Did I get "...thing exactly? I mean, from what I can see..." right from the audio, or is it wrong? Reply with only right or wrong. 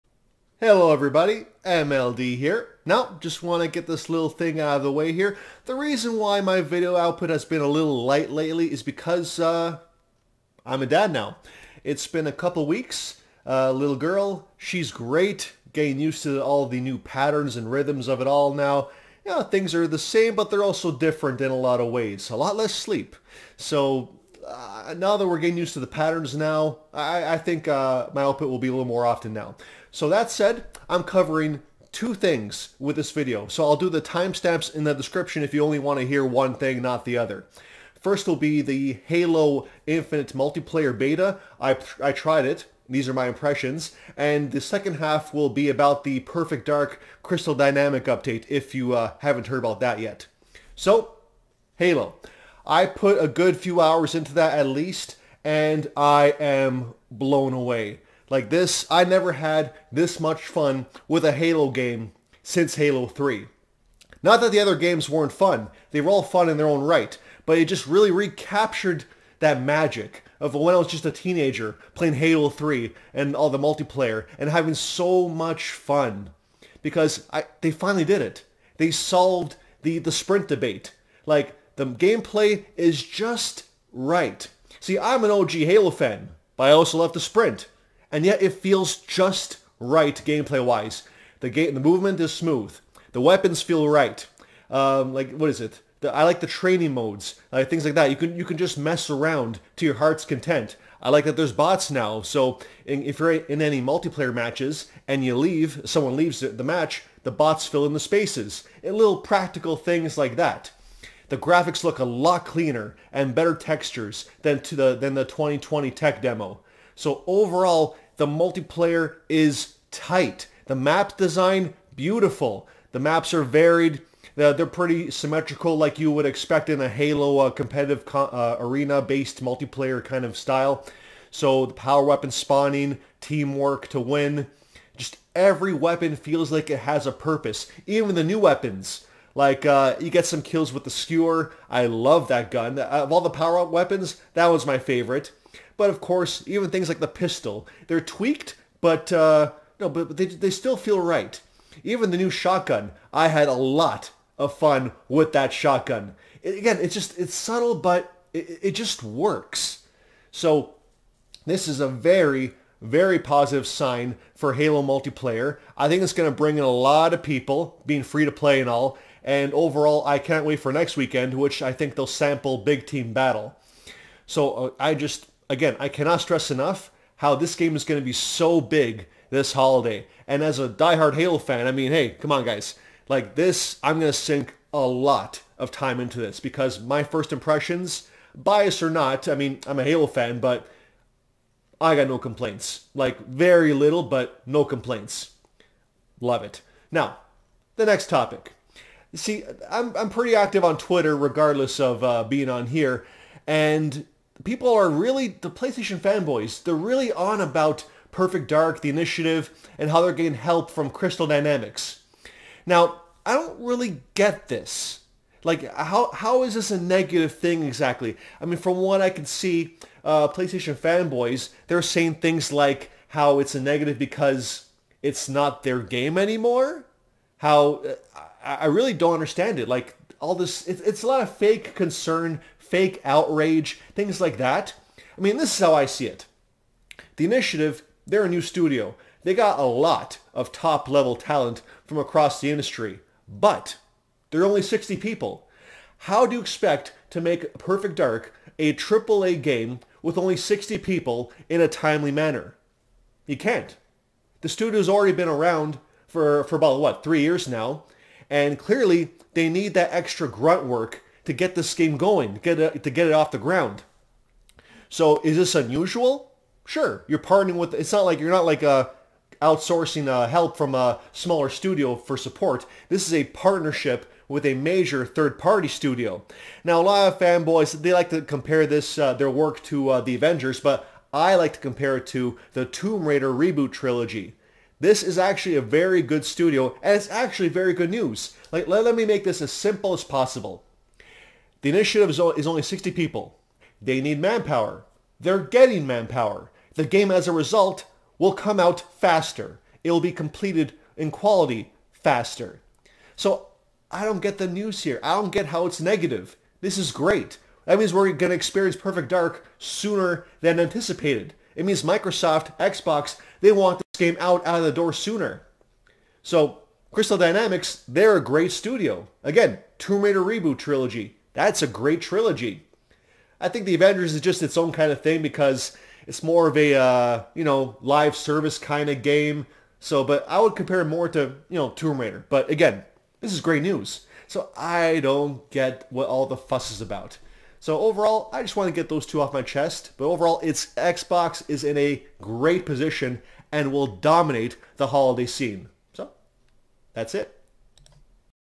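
right.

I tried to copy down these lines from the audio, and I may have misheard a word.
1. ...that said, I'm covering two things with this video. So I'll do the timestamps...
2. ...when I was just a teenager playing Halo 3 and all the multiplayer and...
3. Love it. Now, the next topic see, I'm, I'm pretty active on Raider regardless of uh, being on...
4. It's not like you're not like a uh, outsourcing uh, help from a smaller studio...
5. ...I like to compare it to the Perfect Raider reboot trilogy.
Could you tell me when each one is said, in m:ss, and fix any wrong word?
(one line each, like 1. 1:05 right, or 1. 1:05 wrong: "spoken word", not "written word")
1. 0:30 right
2. 1:10 right
3. 3:16 wrong: "Twitter", not "Raider"
4. 4:27 right
5. 4:41 wrong: "Tomb", not "Perfect".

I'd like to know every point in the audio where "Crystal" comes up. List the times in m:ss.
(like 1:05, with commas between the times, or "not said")
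0:47, 3:30, 5:16.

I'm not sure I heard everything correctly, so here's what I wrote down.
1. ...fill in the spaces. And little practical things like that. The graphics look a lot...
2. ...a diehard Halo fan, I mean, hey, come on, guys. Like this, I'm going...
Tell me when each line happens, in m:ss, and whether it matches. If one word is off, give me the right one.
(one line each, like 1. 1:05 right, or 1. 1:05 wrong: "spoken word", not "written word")
1. 1:47 right
2. 3:00 right.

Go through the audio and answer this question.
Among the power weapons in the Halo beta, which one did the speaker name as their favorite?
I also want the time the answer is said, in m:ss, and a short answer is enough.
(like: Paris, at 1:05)
skewer, at 2:20.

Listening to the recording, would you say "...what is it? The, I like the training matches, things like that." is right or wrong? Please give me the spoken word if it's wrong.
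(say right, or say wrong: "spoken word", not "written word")
wrong: "modes", not "matches".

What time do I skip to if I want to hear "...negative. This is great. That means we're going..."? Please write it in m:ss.
5:05.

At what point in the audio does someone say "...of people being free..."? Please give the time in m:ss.
2:47.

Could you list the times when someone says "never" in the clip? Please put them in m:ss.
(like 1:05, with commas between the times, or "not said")
0:59.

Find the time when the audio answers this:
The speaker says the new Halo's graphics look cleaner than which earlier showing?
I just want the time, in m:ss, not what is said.
1:55.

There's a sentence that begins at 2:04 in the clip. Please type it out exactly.
They're, pretty symmetrical like you would expect in a Halo uh, competitive co uh, arena-based multiplayer kind of style.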